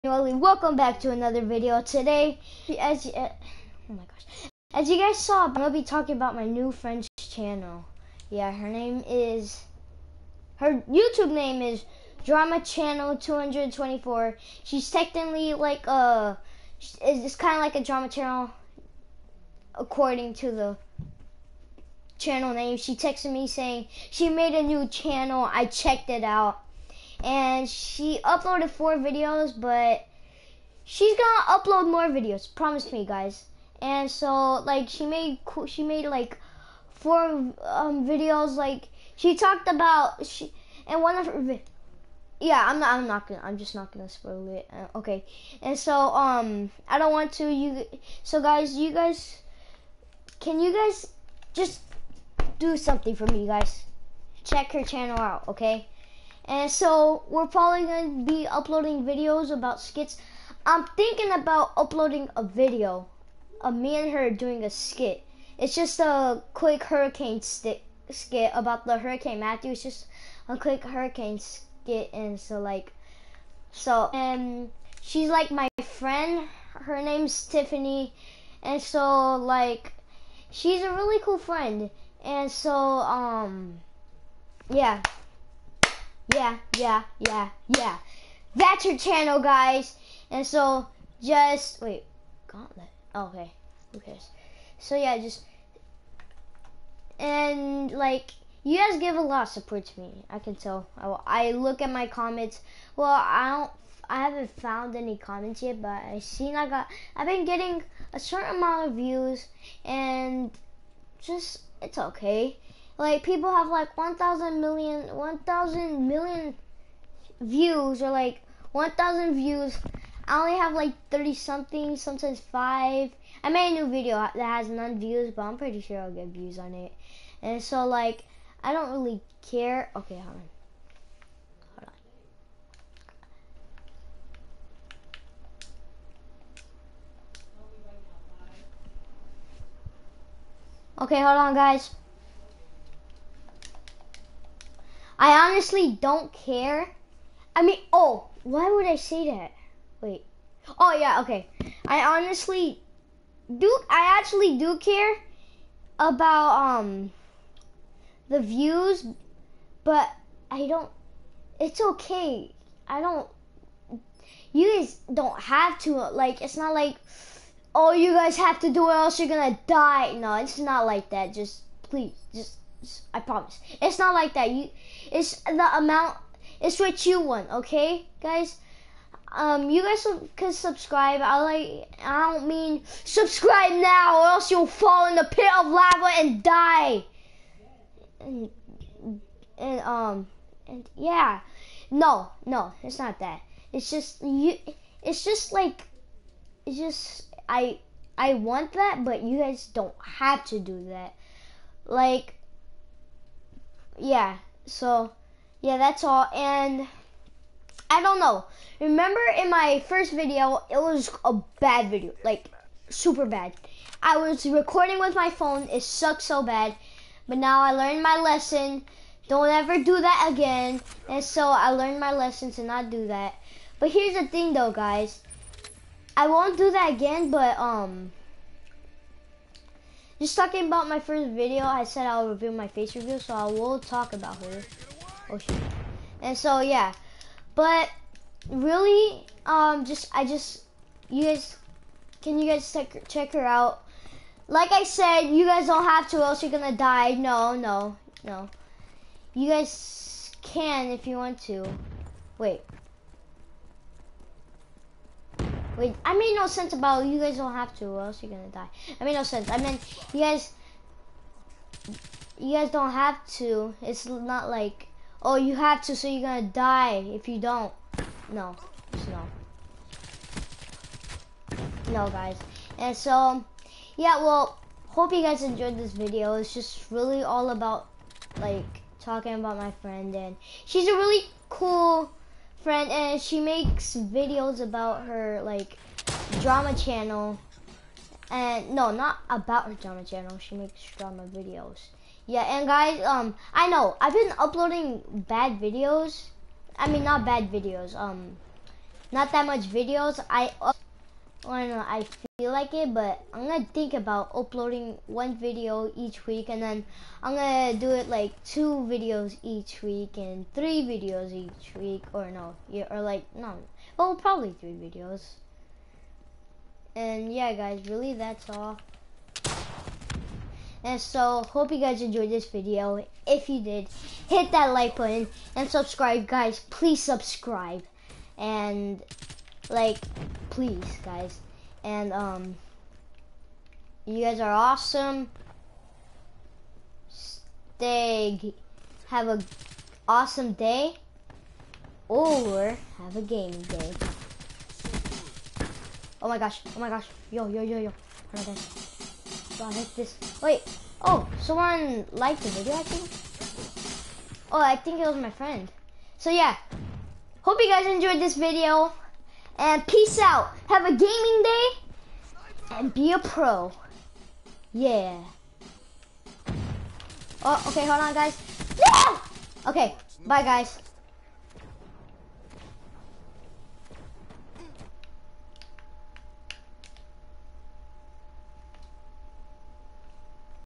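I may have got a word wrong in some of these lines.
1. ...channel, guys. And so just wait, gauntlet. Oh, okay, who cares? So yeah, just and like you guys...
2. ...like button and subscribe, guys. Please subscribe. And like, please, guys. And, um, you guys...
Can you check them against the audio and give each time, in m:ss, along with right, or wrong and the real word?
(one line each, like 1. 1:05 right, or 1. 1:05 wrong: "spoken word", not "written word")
1. 1:28 right
2. 5:24 right.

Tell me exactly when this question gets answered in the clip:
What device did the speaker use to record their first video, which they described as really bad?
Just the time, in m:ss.
3:35.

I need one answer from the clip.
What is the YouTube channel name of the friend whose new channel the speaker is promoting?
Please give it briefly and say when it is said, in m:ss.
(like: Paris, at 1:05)
Drama Channel 224, at 0:12.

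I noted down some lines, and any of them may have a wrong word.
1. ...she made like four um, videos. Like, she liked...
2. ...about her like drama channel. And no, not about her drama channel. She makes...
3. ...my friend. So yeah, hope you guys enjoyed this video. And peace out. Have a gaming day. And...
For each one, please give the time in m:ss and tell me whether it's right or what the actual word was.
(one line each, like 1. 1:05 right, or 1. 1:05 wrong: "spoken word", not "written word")
1. 0:35 wrong: "talked", not "liked"
2. 4:44 right
3. 5:55 right.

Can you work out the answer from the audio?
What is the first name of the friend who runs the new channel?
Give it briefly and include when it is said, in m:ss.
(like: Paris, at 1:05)
Tiffany, at 1:17.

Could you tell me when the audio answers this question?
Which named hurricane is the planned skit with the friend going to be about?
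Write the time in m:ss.
1:08.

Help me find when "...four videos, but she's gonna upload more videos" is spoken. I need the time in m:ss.
0:28.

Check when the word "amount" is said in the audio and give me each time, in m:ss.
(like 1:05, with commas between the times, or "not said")
1:48, 2:55.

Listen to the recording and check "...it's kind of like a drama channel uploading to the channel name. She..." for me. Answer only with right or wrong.
wrong.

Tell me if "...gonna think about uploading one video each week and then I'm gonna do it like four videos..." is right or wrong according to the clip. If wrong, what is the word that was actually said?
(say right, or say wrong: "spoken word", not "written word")
wrong: "two", not "four".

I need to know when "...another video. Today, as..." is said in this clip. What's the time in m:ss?
0:01.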